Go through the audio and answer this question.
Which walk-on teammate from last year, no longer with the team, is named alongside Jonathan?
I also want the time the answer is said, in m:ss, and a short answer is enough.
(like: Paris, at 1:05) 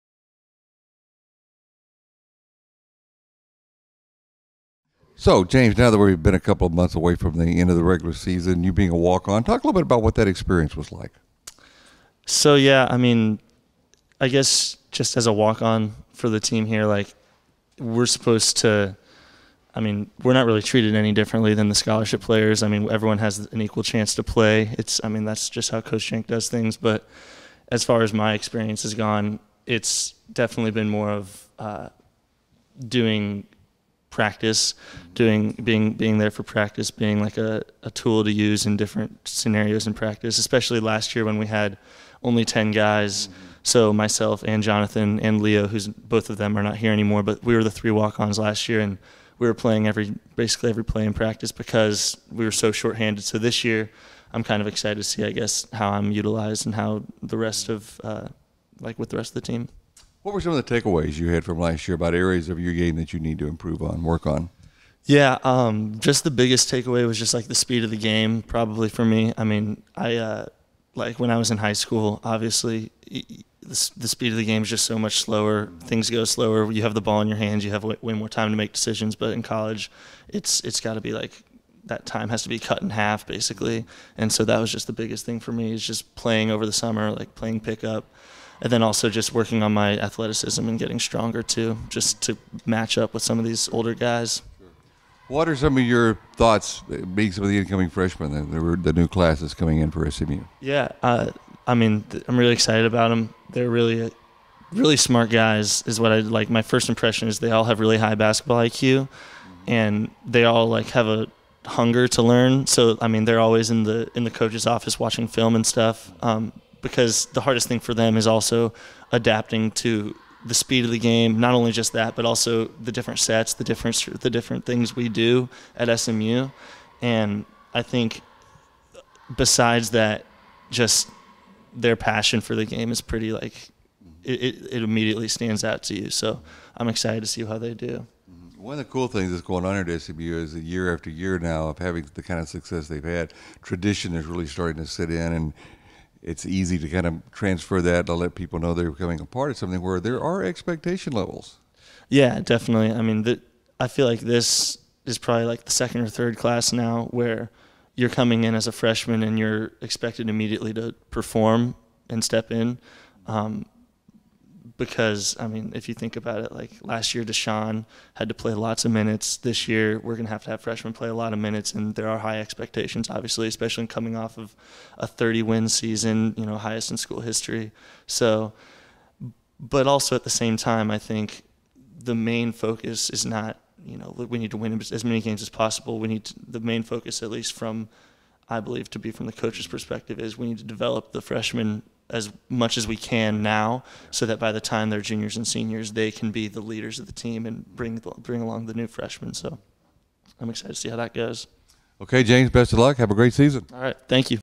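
Leo, at 0:45.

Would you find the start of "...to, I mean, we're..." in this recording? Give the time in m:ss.
0:18.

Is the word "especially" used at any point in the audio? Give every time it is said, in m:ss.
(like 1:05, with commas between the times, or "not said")
0:40, 2:53.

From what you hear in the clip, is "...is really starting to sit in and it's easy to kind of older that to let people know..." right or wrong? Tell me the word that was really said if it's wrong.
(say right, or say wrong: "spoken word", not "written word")
wrong: "transfer", not "older".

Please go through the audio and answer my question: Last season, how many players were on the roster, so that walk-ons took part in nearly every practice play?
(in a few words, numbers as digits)
10.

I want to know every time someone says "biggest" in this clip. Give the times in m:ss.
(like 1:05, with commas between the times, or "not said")
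1:06, 1:24.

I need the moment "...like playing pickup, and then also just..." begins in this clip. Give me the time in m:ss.
1:27.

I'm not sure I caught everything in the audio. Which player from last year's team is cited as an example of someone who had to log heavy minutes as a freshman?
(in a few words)
Deshaun.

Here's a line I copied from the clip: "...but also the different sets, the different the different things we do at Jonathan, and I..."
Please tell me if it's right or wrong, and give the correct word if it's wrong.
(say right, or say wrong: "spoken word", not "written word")
wrong: "SMU", not "Jonathan".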